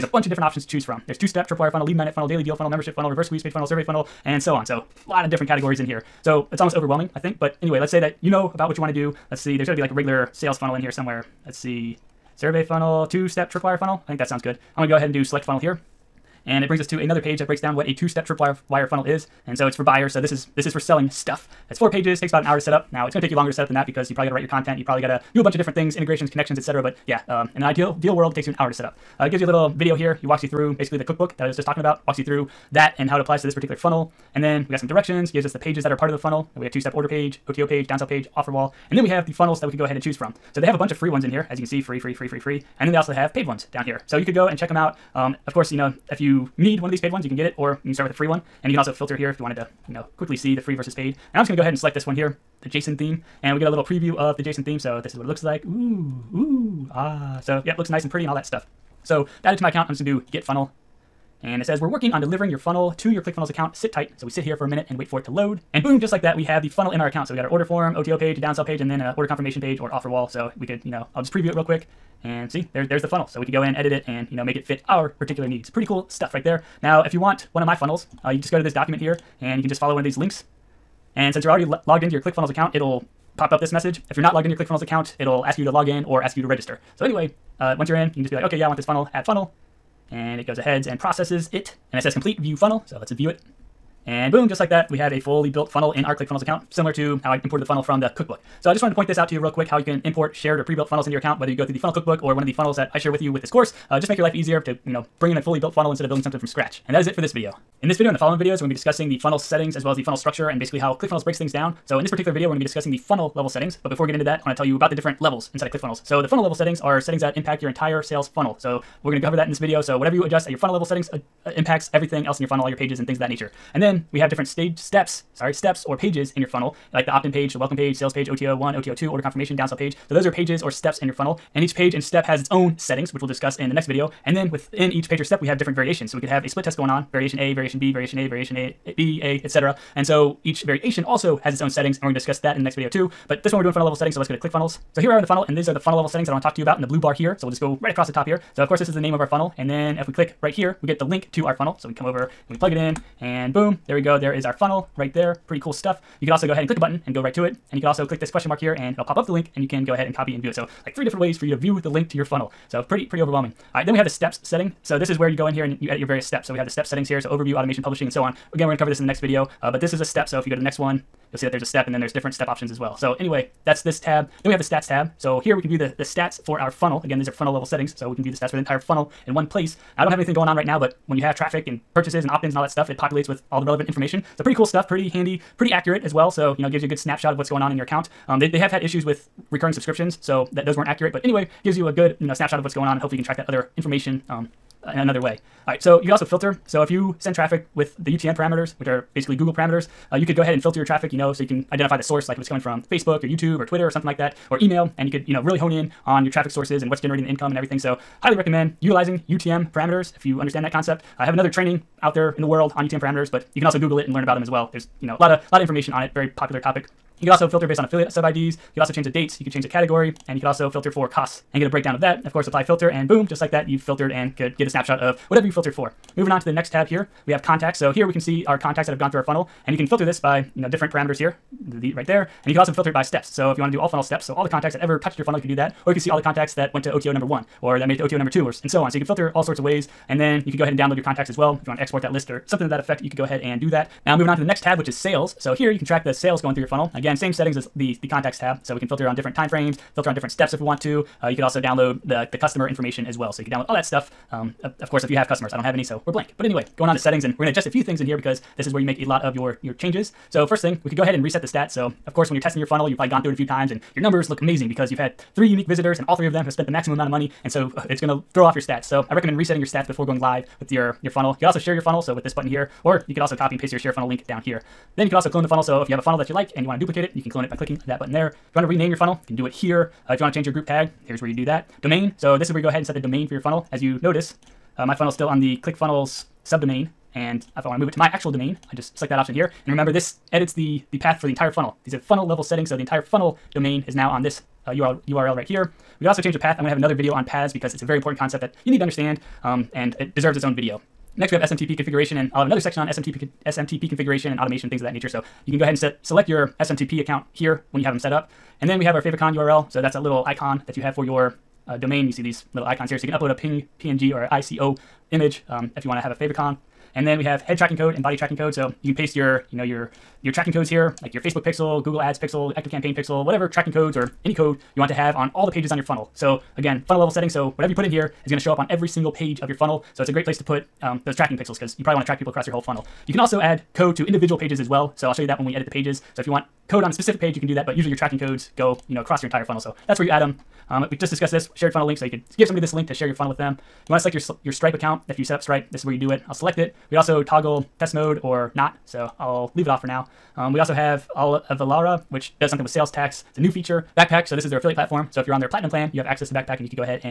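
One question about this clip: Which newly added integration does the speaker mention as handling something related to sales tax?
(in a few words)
Avalara.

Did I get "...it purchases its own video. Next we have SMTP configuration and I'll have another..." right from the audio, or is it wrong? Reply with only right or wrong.
wrong.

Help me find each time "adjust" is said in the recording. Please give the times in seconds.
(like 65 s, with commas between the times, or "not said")
120 s, 257 s.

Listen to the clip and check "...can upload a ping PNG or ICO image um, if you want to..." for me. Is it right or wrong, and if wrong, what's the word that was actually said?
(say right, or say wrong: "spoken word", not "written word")
right.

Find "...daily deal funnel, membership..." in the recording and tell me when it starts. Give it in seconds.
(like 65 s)
2 s.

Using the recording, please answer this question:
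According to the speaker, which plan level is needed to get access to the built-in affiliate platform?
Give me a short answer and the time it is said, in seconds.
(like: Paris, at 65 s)
platinum plan, at 355 s.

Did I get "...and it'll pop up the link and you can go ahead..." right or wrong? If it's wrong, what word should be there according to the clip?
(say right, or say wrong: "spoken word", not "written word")
right.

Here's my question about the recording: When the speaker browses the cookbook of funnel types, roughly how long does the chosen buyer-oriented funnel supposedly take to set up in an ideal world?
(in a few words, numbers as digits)
about an hour.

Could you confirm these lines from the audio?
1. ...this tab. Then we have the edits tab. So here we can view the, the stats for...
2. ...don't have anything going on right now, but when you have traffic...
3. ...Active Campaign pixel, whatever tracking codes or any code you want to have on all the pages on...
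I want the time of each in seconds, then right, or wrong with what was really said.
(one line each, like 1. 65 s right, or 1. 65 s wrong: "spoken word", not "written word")
1. 173 s wrong: "stats", not "edits"
2. 180 s right
3. 322 s right.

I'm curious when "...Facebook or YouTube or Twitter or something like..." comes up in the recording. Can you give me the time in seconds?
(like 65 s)
202 s.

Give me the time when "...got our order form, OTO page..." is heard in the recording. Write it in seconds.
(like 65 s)
67 s.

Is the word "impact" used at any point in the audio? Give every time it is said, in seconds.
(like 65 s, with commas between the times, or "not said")
117 s, 121 s.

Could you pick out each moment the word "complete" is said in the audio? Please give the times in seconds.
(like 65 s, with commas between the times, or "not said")
92 s.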